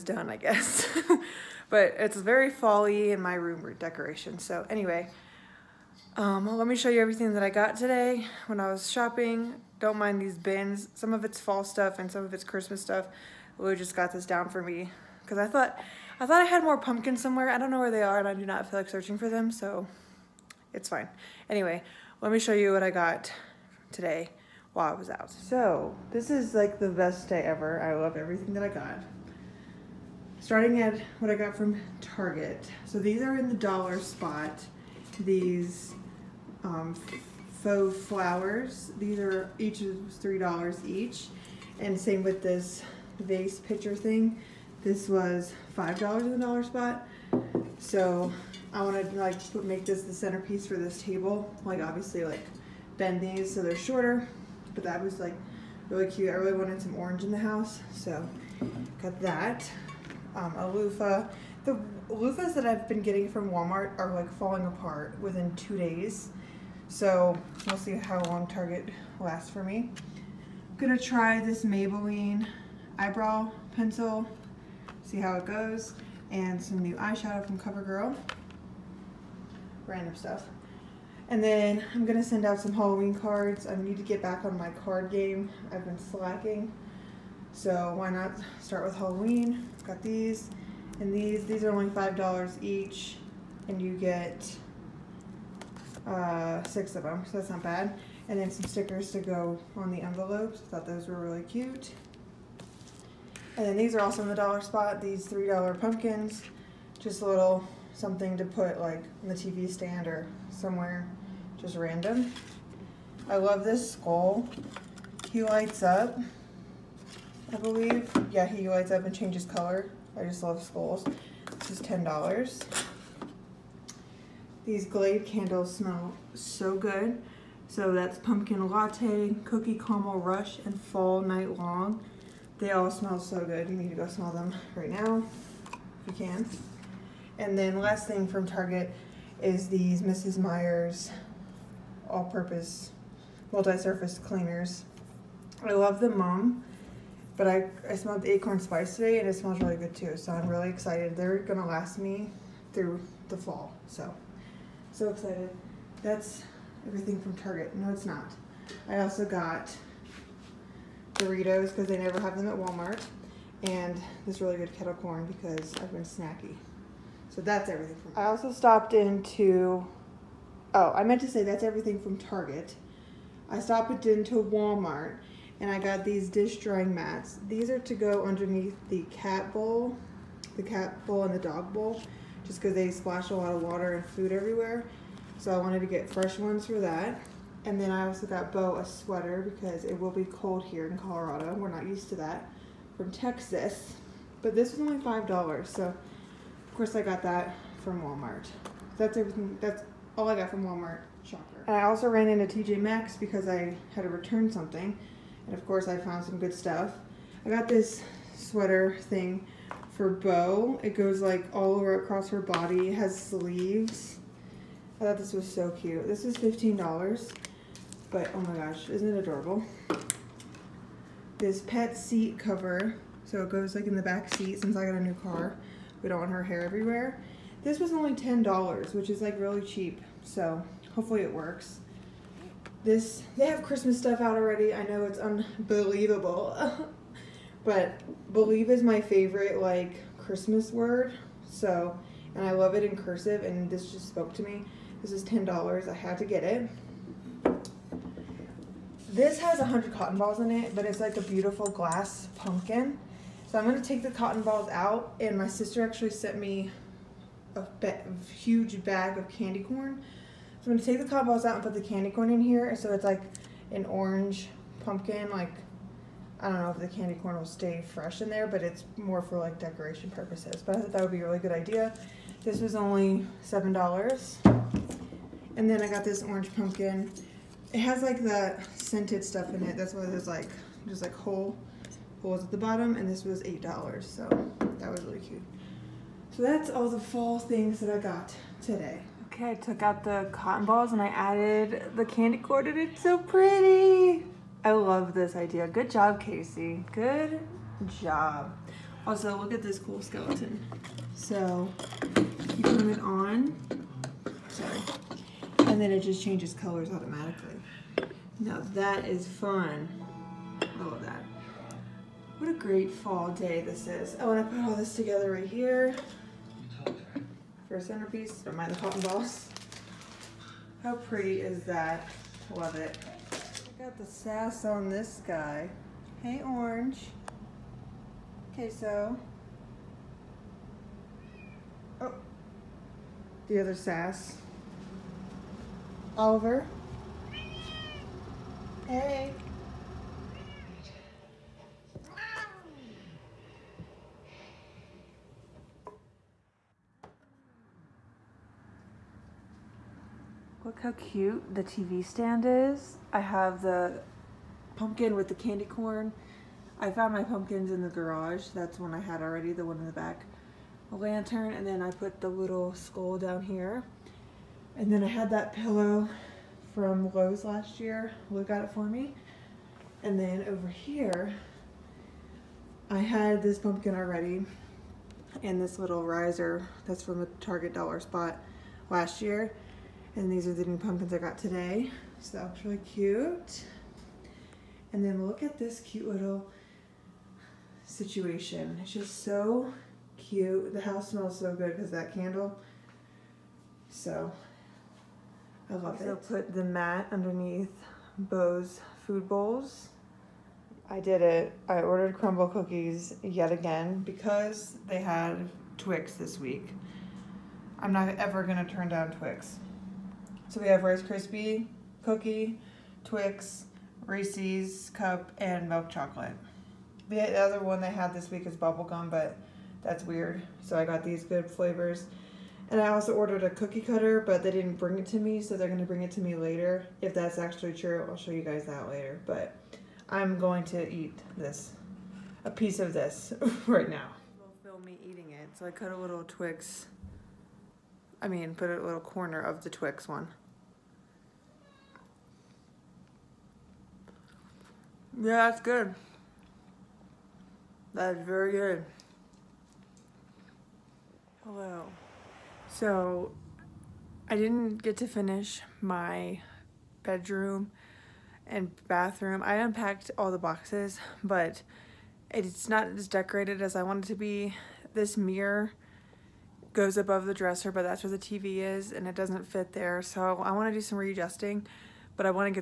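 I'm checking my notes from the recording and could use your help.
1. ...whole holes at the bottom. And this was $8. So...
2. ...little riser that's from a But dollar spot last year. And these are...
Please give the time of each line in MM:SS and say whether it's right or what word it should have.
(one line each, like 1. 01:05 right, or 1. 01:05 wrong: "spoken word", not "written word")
1. 04:41 right
2. 06:15 wrong: "Target", not "But".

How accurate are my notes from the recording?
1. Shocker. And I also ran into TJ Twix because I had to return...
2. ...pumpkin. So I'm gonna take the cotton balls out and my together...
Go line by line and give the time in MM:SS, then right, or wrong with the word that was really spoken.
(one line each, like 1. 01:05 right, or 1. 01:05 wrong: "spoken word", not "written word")
1. 03:21 wrong: "Maxx", not "Twix"
2. 04:12 wrong: "sister", not "together".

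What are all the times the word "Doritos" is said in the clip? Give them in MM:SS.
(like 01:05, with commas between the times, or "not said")
02:41.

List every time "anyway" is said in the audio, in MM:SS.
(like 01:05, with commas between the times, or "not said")
00:04, 00:21.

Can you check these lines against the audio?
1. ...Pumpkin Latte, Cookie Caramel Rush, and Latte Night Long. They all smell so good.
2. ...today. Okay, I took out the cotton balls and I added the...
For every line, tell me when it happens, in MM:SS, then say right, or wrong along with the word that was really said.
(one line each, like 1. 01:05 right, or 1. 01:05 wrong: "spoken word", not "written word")
1. 02:08 wrong: "Fall", not "Latte"
2. 04:48 right.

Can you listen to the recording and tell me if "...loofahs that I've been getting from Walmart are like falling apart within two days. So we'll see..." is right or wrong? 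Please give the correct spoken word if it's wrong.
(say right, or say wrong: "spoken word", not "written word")
right.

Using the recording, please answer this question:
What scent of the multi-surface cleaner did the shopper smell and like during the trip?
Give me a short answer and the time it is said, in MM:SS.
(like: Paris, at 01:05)
acorn spice, at 02:28.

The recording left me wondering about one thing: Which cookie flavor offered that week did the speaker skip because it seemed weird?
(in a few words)
bubblegum.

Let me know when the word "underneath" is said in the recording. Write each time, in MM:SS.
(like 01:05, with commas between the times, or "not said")
02:58, 06:37.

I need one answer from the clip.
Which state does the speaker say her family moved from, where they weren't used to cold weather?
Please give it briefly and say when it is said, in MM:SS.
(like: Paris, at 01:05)
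Texas, at 03:13.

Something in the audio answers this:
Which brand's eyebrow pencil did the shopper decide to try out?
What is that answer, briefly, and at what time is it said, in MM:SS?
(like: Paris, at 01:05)
Maybelline, at 01:11.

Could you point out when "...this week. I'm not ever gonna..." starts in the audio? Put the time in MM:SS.
06:46.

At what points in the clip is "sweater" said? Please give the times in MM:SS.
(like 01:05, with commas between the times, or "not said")
03:08, 03:28.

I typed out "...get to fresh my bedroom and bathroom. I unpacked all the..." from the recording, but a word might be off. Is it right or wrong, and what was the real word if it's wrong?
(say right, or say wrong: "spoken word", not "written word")
wrong: "finish", not "fresh".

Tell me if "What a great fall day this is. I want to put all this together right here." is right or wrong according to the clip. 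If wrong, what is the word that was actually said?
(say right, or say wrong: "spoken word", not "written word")
right.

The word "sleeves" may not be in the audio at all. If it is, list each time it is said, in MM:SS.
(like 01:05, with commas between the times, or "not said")
03:33.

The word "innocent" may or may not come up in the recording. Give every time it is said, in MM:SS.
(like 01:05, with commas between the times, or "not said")
not said.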